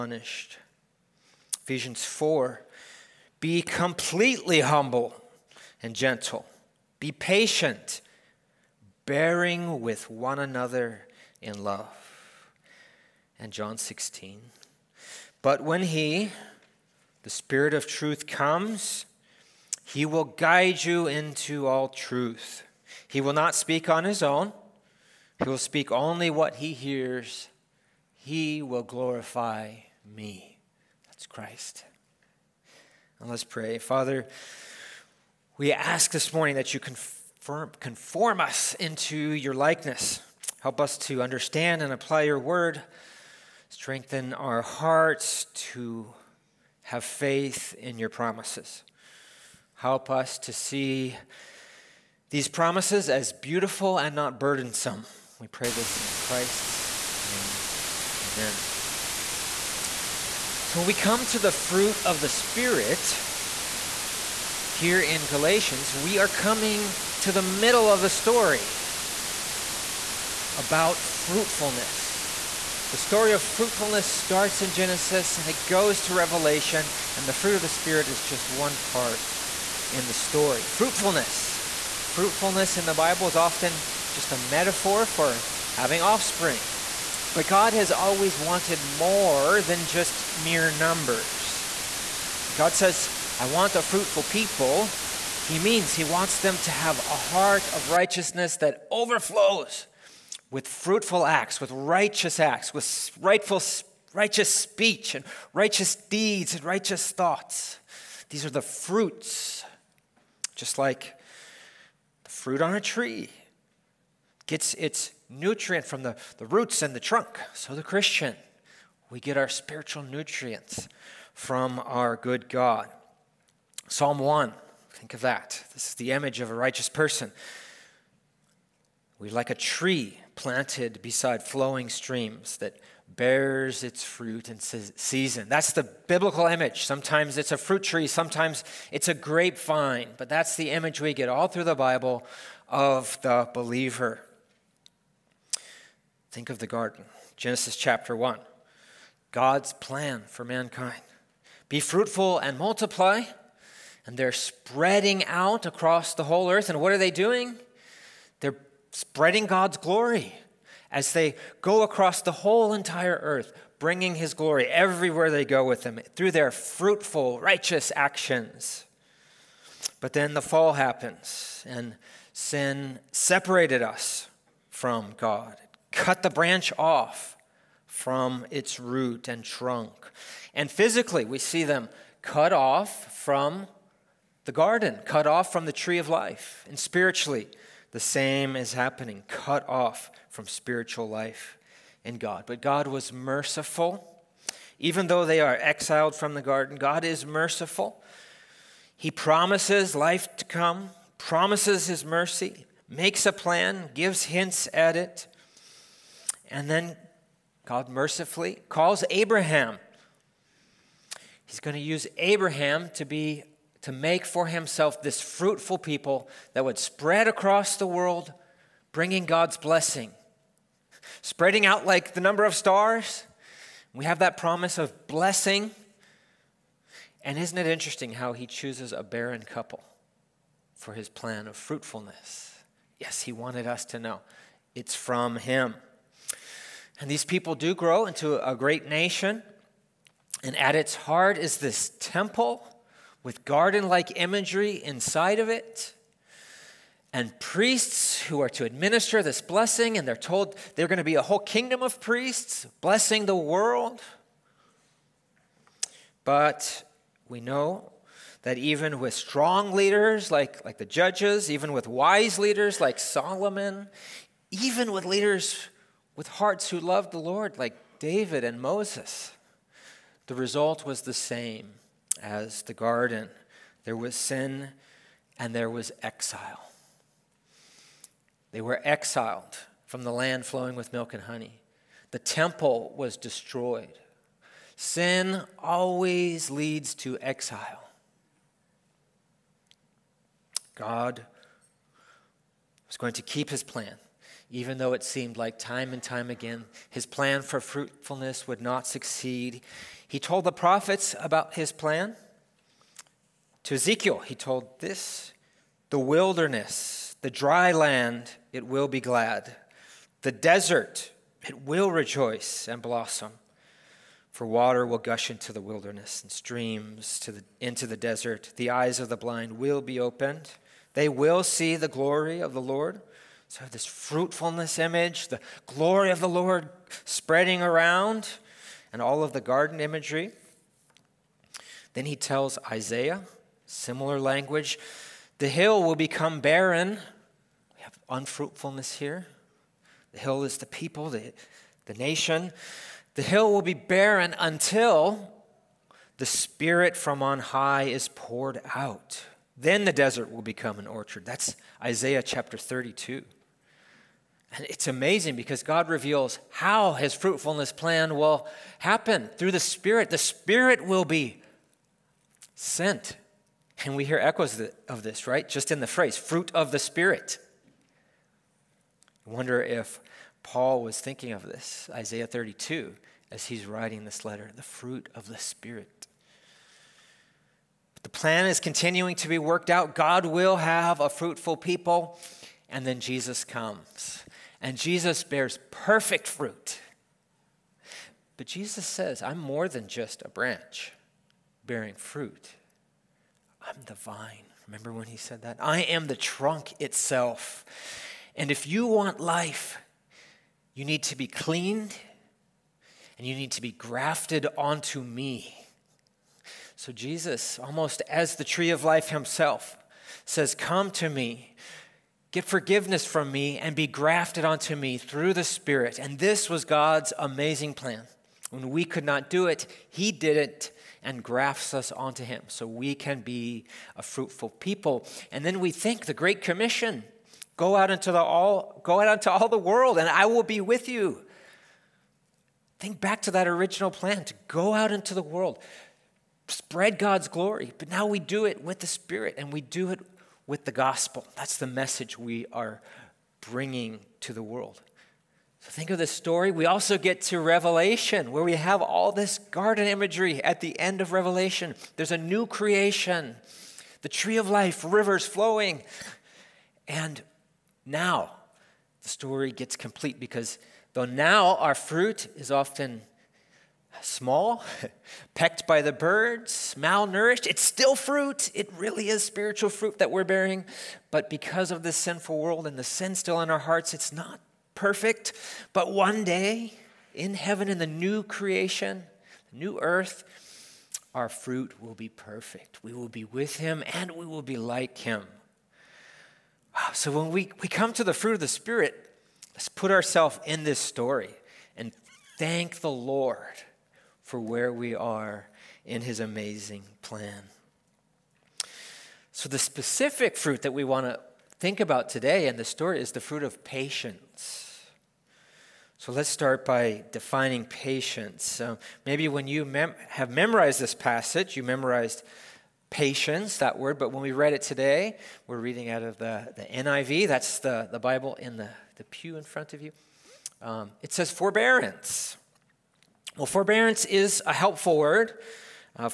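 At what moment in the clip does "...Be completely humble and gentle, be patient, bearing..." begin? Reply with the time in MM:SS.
00:03.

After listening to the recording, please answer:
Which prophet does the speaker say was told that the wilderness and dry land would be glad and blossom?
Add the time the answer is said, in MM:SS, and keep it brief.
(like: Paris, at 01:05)
Ezekiel, at 05:03.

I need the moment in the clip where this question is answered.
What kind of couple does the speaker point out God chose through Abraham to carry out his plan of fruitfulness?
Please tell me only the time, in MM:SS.
03:49.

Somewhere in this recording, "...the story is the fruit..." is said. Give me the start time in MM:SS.
08:22.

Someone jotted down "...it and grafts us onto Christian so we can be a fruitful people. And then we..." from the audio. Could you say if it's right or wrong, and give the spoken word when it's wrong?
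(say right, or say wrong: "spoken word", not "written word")
wrong: "Him", not "Christian".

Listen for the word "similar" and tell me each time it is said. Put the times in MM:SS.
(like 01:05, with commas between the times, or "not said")
05:33.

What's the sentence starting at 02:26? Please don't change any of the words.
Think of the garden, Genesis chapter 1.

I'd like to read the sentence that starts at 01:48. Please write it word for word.
These are the fruits, just like the fruit on a tree gets its nutrient from the, the roots and the trunk.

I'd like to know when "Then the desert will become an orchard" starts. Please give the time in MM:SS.
05:49.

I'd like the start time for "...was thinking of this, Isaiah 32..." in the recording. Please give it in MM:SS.
06:10.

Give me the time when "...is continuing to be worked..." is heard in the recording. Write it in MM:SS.
06:18.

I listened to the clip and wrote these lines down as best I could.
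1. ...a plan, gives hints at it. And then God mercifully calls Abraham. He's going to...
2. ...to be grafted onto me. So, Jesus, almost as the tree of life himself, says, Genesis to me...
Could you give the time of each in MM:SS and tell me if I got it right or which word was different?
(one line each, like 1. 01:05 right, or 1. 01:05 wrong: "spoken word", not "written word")
1. 03:23 right
2. 06:43 wrong: "Come", not "Genesis".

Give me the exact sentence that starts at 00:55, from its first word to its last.
We pray this in Christ's name.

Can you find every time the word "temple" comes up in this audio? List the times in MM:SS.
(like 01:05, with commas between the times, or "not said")
04:01, 04:42.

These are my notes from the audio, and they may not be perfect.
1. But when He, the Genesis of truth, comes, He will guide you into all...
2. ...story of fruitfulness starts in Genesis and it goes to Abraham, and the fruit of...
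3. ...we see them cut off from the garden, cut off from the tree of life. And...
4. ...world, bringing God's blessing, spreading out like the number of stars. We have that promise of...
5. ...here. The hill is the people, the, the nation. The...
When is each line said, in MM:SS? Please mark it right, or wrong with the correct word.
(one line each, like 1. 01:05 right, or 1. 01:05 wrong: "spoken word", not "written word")
1. 00:15 wrong: "Spirit", not "Genesis"
2. 01:12 wrong: "Revelation", not "Abraham"
3. 03:01 right
4. 03:37 right
5. 05:38 right.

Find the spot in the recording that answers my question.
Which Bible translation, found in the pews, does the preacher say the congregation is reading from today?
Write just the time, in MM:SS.
08:36.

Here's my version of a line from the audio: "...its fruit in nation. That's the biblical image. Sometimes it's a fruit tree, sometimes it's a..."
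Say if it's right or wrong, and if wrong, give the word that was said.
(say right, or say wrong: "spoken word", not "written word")
wrong: "season", not "nation".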